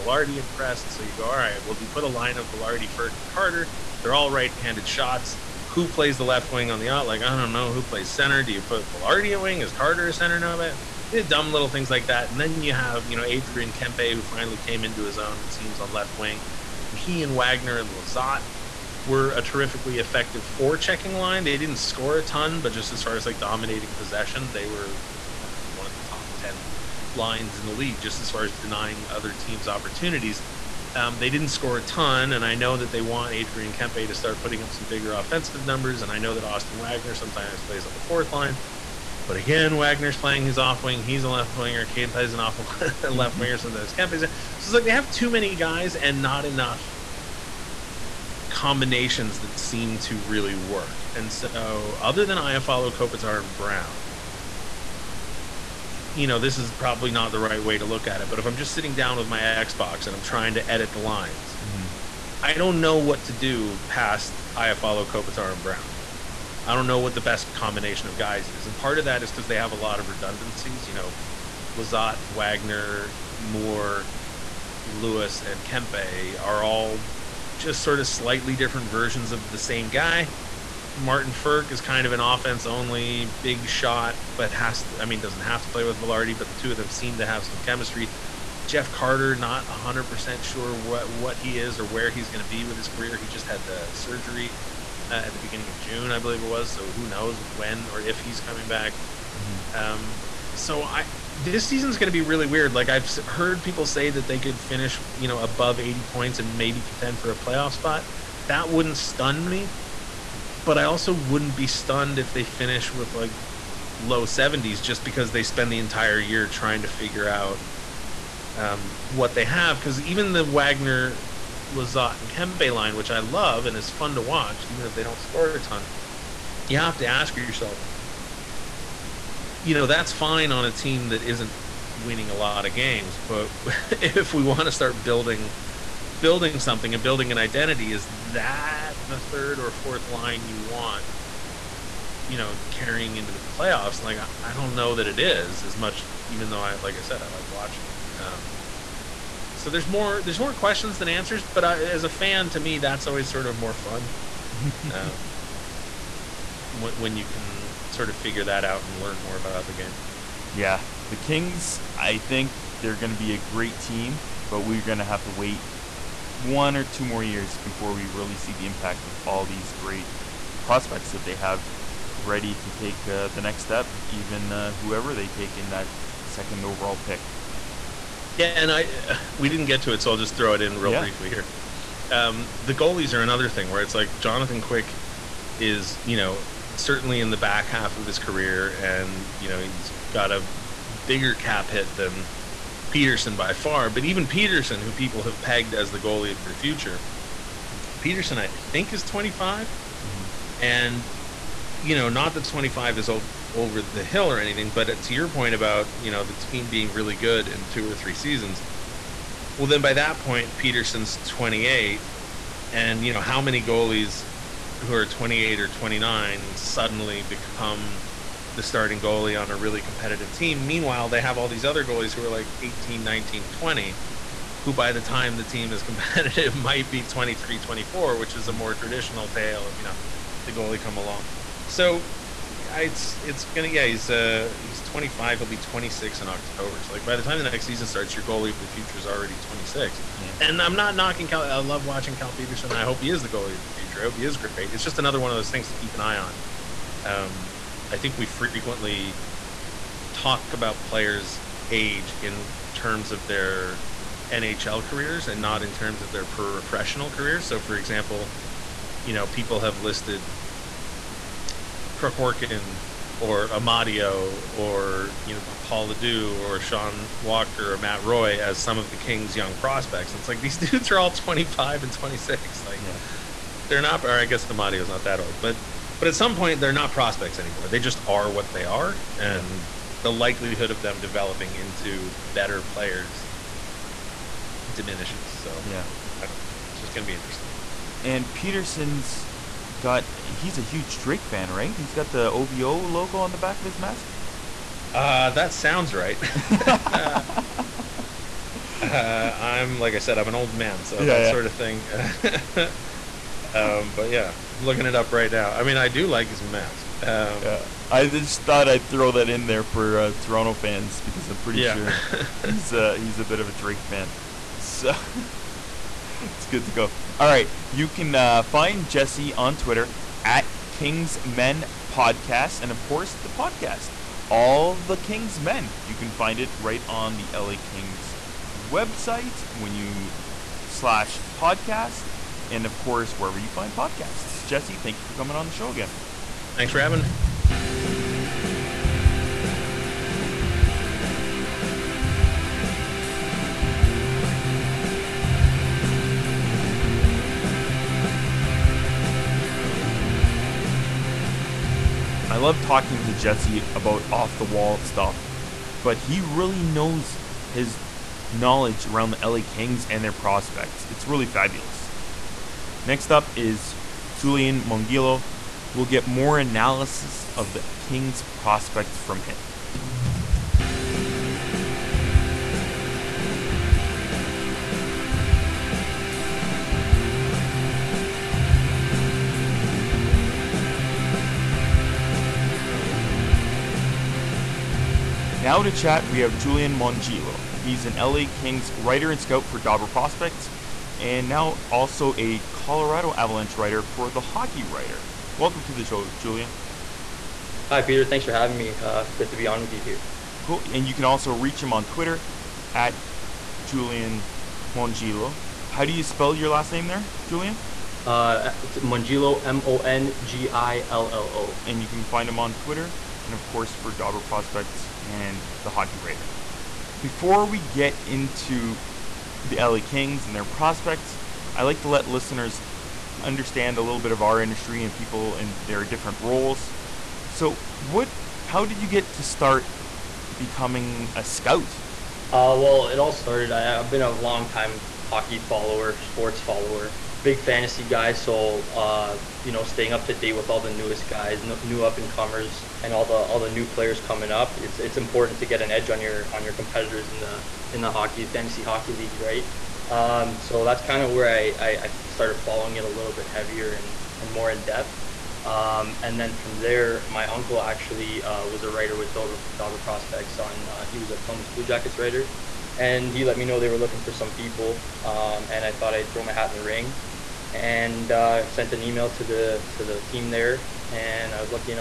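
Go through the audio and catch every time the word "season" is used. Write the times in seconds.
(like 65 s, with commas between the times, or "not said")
101 s, 208 s, 237 s.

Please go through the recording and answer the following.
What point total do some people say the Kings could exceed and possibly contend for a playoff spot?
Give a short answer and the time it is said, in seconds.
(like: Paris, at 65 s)
80 points, at 105 s.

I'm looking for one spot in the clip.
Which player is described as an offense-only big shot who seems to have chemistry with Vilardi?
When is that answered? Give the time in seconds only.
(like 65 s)
80 s.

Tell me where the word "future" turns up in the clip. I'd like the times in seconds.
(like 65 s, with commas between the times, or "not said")
196 s, 238 s, 243 s.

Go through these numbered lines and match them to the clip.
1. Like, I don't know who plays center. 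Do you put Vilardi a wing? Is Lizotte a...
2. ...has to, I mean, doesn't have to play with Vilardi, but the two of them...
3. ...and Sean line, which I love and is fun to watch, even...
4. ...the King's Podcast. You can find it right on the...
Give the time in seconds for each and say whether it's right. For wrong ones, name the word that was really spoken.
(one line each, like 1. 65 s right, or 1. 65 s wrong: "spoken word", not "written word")
1. 7 s wrong: "Carter", not "Lizotte"
2. 84 s right
3. 122 s wrong: "Kempe", not "Sean"
4. 324 s wrong: "Men", not "Podcast".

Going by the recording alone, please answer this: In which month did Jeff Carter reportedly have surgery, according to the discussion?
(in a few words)
June.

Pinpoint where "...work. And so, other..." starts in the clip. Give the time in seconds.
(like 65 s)
50 s.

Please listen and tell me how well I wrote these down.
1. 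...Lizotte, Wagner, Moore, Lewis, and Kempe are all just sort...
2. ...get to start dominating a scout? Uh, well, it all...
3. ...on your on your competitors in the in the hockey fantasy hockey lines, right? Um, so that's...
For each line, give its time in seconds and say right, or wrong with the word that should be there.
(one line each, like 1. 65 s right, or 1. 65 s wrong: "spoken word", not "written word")
1. 71 s right
2. 428 s wrong: "becoming", not "dominating"
3. 445 s wrong: "leagues", not "lines".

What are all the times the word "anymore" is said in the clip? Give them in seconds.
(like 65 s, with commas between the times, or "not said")
277 s.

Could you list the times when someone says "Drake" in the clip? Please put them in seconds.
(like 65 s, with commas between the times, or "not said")
290 s, 313 s.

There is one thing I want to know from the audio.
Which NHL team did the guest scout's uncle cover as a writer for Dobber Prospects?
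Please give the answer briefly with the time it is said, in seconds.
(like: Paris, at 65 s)
Columbus Blue Jackets, at 461 s.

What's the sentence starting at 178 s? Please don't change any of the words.
Yeah, and I uh, we didn't get to it, so I'll just throw it in real yeah.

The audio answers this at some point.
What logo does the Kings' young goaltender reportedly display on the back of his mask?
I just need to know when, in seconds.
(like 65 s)
292 s.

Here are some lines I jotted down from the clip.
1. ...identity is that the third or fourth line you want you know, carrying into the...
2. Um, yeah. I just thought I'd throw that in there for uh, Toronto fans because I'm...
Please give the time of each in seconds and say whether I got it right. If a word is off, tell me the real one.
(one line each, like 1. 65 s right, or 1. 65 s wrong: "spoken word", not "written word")
1. 137 s right
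2. 307 s right.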